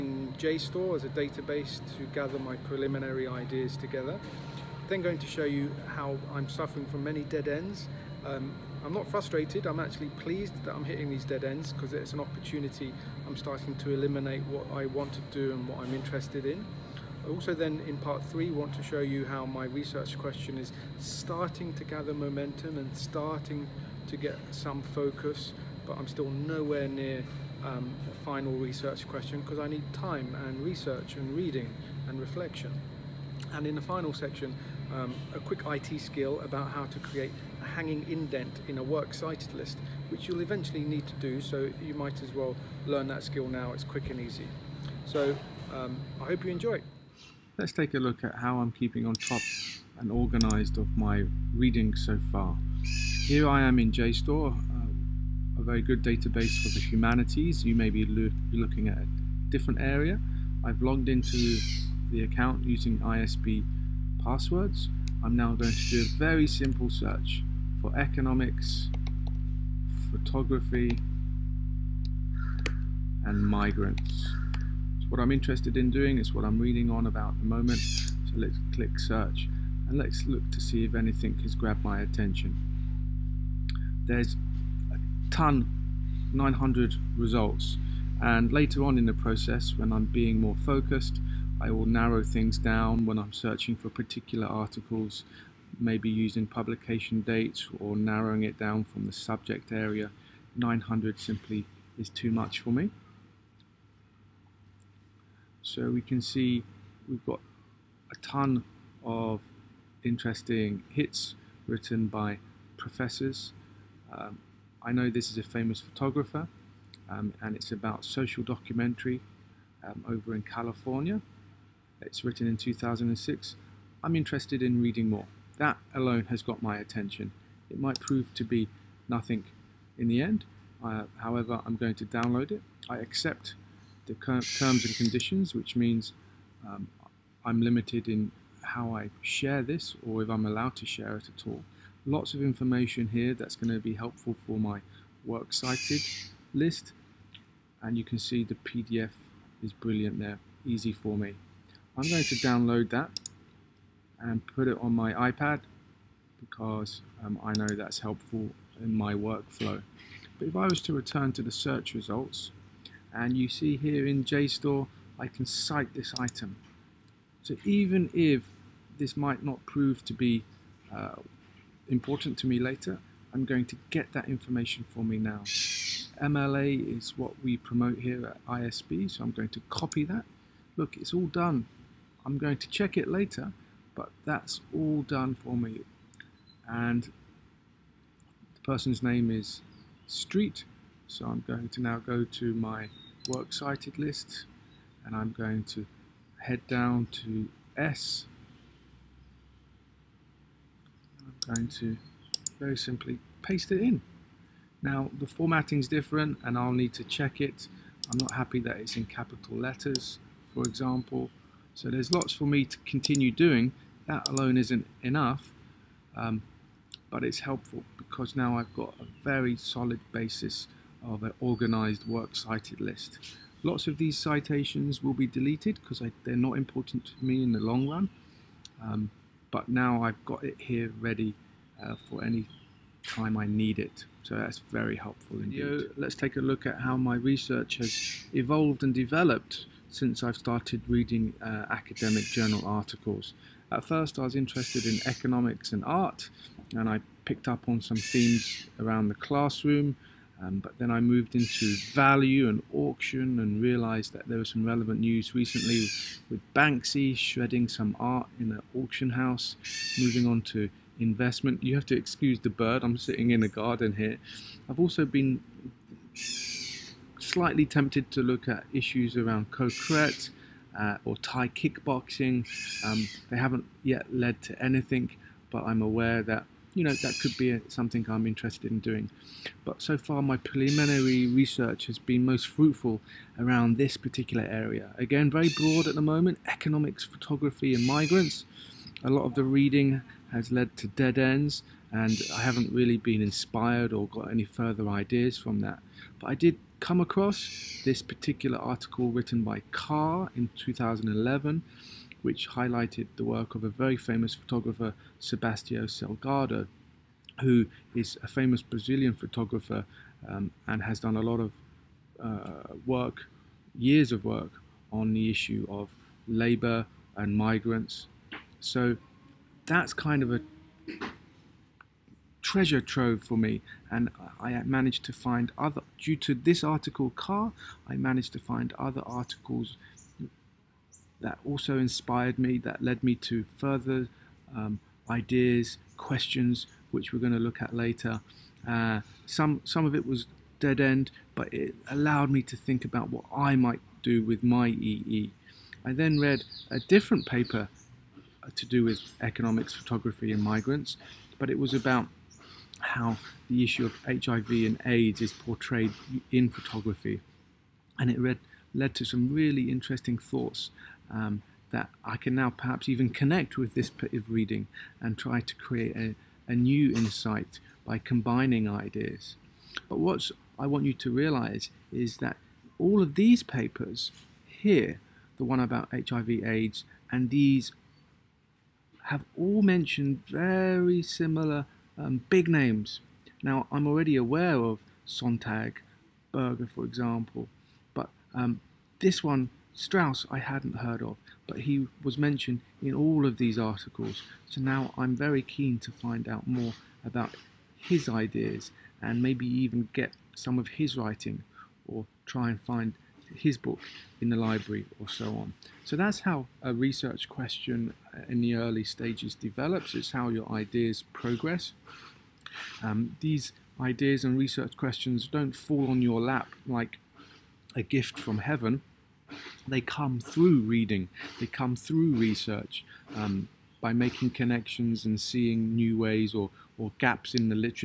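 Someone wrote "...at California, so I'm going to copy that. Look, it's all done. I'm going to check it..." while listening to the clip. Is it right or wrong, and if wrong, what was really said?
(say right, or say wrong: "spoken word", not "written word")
wrong: "ISB", not "California".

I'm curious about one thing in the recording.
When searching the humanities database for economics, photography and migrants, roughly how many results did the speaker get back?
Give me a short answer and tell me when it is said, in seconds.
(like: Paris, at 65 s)
900, at 86 s.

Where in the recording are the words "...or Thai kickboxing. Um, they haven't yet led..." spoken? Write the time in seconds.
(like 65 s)
271 s.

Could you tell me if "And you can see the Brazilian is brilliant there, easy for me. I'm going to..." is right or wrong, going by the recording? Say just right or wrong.
wrong.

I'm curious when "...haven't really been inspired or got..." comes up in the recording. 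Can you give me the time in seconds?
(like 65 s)
292 s.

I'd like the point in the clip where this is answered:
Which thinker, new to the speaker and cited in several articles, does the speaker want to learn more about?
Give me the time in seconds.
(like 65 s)
389 s.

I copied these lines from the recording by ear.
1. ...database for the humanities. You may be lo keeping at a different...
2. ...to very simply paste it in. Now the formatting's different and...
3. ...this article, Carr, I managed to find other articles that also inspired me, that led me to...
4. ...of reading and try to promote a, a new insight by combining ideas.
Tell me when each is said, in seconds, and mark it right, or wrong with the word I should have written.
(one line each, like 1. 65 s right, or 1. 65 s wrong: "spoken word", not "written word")
1. 56 s wrong: "looking", not "keeping"
2. 201 s right
3. 326 s right
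4. 364 s wrong: "create", not "promote".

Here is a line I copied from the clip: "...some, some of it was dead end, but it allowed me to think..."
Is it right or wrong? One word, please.
right.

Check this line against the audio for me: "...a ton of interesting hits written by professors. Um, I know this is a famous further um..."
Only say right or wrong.
wrong.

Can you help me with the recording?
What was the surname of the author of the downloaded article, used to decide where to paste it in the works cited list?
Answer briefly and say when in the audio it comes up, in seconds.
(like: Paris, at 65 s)
Street, at 190 s.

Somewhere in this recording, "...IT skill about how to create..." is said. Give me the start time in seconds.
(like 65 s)
35 s.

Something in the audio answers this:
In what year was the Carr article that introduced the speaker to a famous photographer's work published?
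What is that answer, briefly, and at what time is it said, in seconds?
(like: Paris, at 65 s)
2011, at 300 s.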